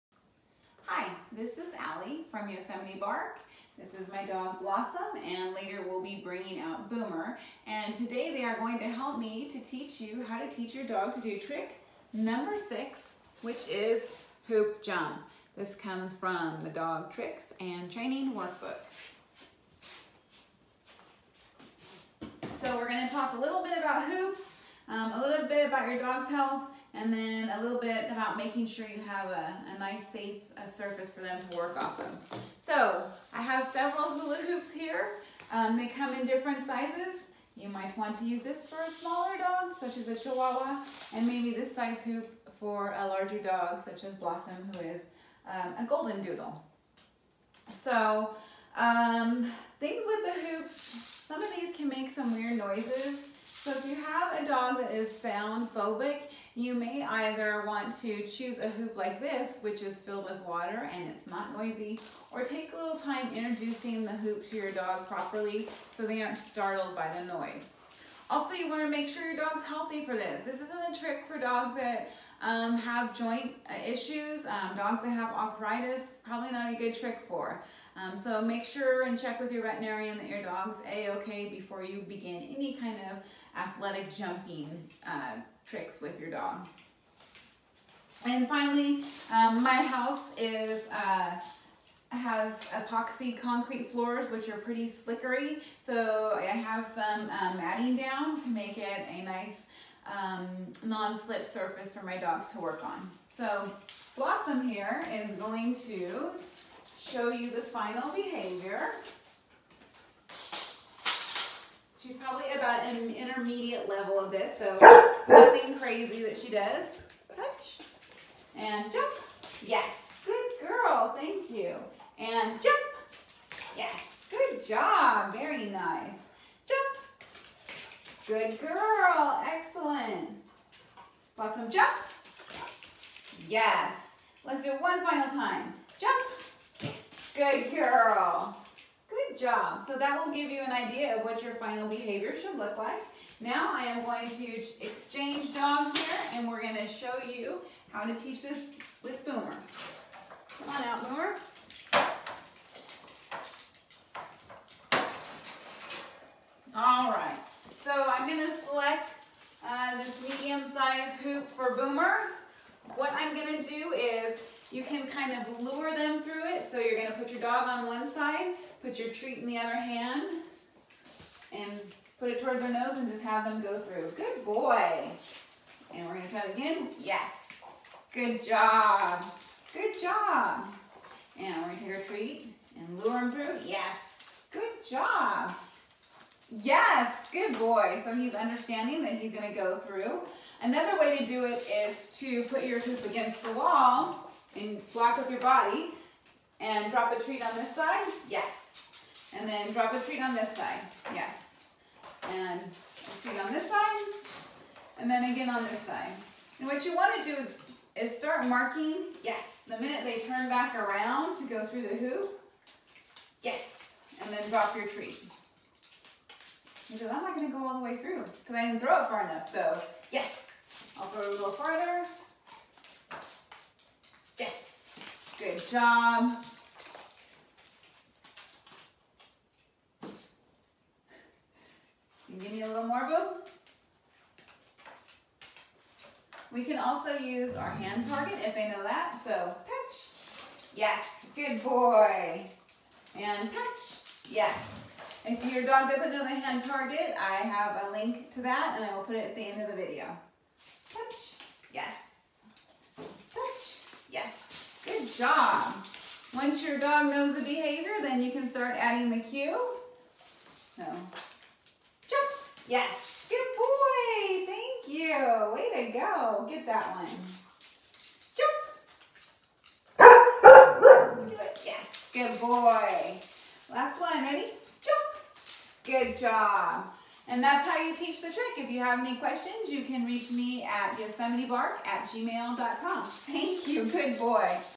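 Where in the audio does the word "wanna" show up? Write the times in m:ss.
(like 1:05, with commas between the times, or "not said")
1:08, 3:26.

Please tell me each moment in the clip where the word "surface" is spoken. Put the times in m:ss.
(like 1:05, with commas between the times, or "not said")
0:30, 1:41.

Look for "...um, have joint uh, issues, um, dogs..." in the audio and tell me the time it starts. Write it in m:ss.
1:12.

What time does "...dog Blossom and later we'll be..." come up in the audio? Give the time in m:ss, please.
0:04.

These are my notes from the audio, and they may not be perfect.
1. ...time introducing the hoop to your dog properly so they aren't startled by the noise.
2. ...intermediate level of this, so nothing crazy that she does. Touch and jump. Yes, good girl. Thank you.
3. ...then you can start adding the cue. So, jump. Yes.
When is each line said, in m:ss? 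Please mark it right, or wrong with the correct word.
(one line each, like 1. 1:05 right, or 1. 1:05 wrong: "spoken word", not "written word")
1. 1:02 right
2. 1:53 right
3. 4:18 right.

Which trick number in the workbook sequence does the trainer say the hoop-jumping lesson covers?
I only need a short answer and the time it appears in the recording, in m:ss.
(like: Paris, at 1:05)
6, at 0:11.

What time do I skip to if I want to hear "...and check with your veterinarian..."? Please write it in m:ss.
1:19.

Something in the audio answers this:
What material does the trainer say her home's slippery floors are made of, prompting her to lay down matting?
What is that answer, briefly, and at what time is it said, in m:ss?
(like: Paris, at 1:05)
Epoxy concrete, at 1:32.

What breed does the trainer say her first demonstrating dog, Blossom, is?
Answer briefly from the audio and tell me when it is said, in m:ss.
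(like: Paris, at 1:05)
Golden doodle, at 0:45.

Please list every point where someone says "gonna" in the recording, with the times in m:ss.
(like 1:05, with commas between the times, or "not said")
0:22, 2:46, 2:56, 3:01, 3:09, 3:37.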